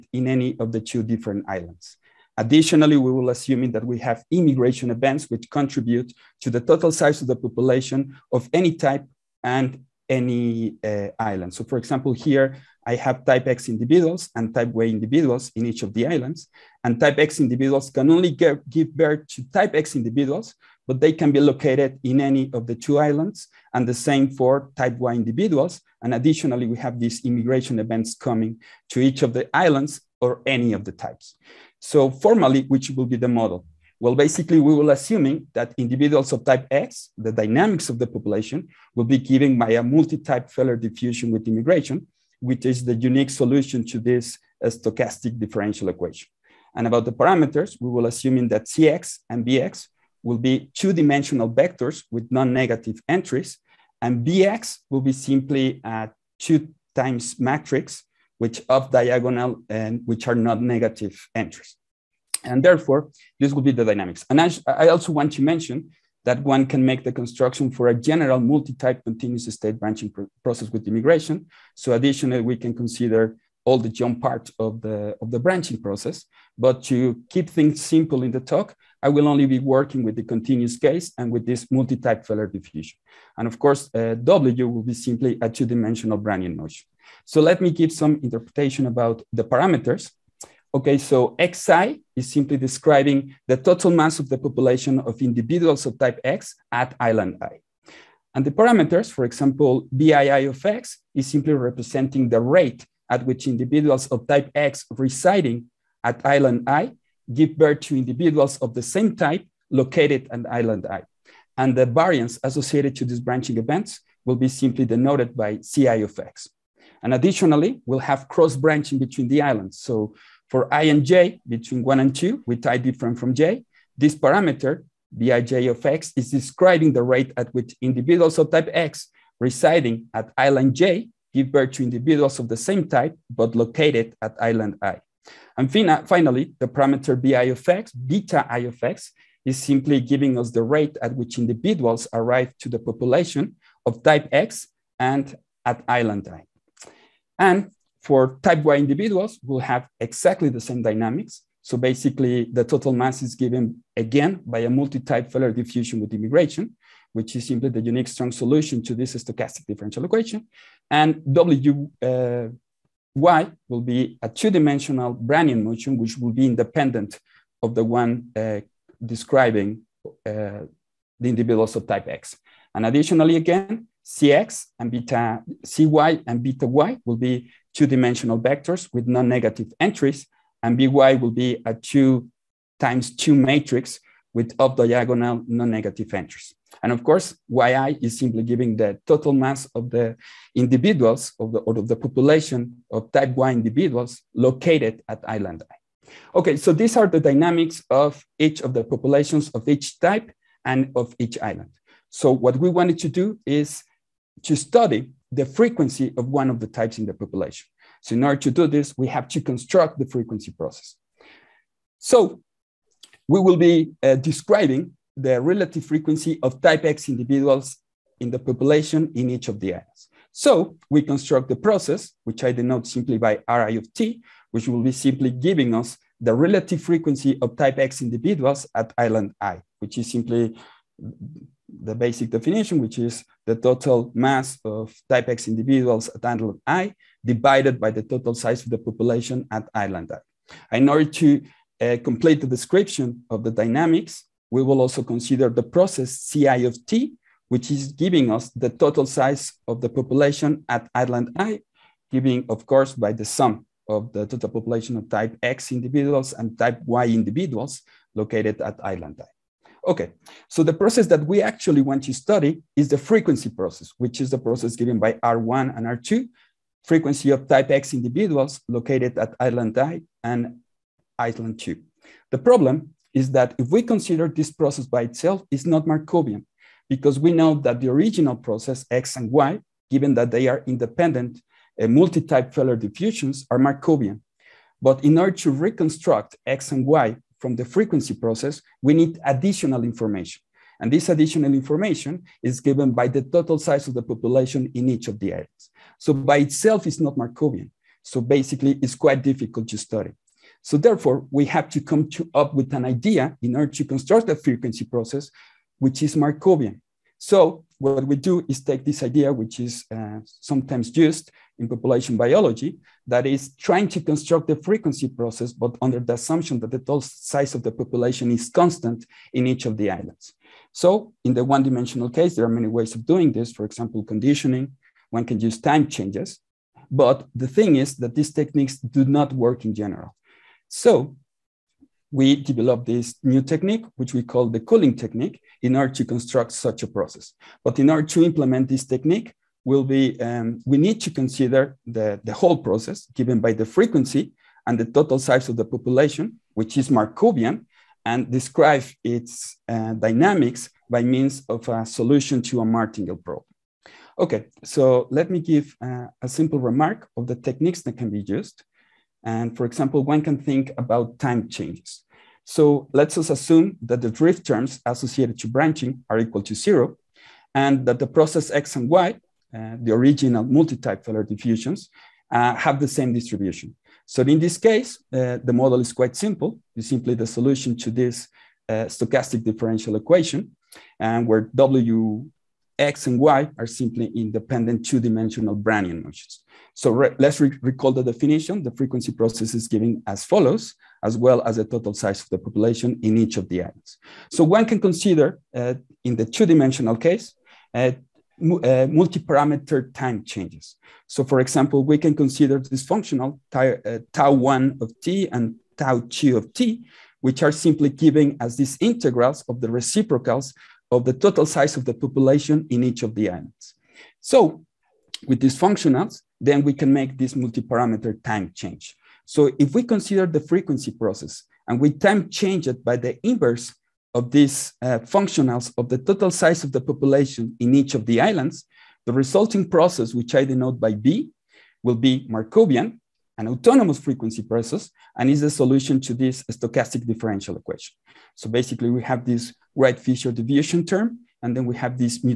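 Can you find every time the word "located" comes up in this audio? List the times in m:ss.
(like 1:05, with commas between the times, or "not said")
0:21, 1:49, 2:13, 3:14, 4:18, 4:28.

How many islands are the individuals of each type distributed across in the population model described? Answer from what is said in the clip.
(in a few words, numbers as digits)
2.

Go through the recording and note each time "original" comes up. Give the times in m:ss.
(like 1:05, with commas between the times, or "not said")
4:37, 6:09.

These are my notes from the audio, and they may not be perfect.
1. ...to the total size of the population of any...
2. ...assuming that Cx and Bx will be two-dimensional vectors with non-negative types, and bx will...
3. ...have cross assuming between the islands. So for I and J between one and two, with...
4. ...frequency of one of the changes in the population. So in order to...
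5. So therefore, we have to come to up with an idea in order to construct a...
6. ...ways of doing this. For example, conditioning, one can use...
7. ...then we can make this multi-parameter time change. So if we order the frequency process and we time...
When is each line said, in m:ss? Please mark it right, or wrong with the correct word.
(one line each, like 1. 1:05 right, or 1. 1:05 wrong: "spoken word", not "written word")
1. 0:06 right
2. 0:48 wrong: "entries", not "types"
3. 1:57 wrong: "branching", not "assuming"
4. 3:25 wrong: "types", not "changes"
5. 5:00 right
6. 5:22 right
7. 6:56 wrong: "consider", not "order".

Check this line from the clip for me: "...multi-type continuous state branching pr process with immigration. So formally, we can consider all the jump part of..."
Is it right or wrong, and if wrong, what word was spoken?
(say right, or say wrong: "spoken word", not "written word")
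wrong: "additionally", not "formally".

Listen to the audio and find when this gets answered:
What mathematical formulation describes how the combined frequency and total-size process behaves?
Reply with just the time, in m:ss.
5:52.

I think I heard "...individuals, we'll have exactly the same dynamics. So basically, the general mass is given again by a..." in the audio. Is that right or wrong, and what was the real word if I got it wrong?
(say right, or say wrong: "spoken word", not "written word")
wrong: "total", not "general".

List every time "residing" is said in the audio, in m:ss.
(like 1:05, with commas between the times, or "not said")
1:44, 2:09.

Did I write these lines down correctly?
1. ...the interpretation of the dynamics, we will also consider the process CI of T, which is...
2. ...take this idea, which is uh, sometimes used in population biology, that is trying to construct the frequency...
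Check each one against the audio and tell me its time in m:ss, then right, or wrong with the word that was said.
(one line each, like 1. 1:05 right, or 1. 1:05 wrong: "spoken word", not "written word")
1. 4:02 wrong: "description", not "interpretation"
2. 5:08 right.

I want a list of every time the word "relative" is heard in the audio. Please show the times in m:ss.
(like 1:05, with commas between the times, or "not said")
3:35, 3:46.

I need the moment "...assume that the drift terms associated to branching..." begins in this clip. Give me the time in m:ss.
6:03.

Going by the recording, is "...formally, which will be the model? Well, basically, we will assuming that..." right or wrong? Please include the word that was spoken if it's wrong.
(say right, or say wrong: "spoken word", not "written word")
right.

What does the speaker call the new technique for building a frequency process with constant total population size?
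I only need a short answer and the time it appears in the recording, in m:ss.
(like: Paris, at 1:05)
Culling technique, at 5:34.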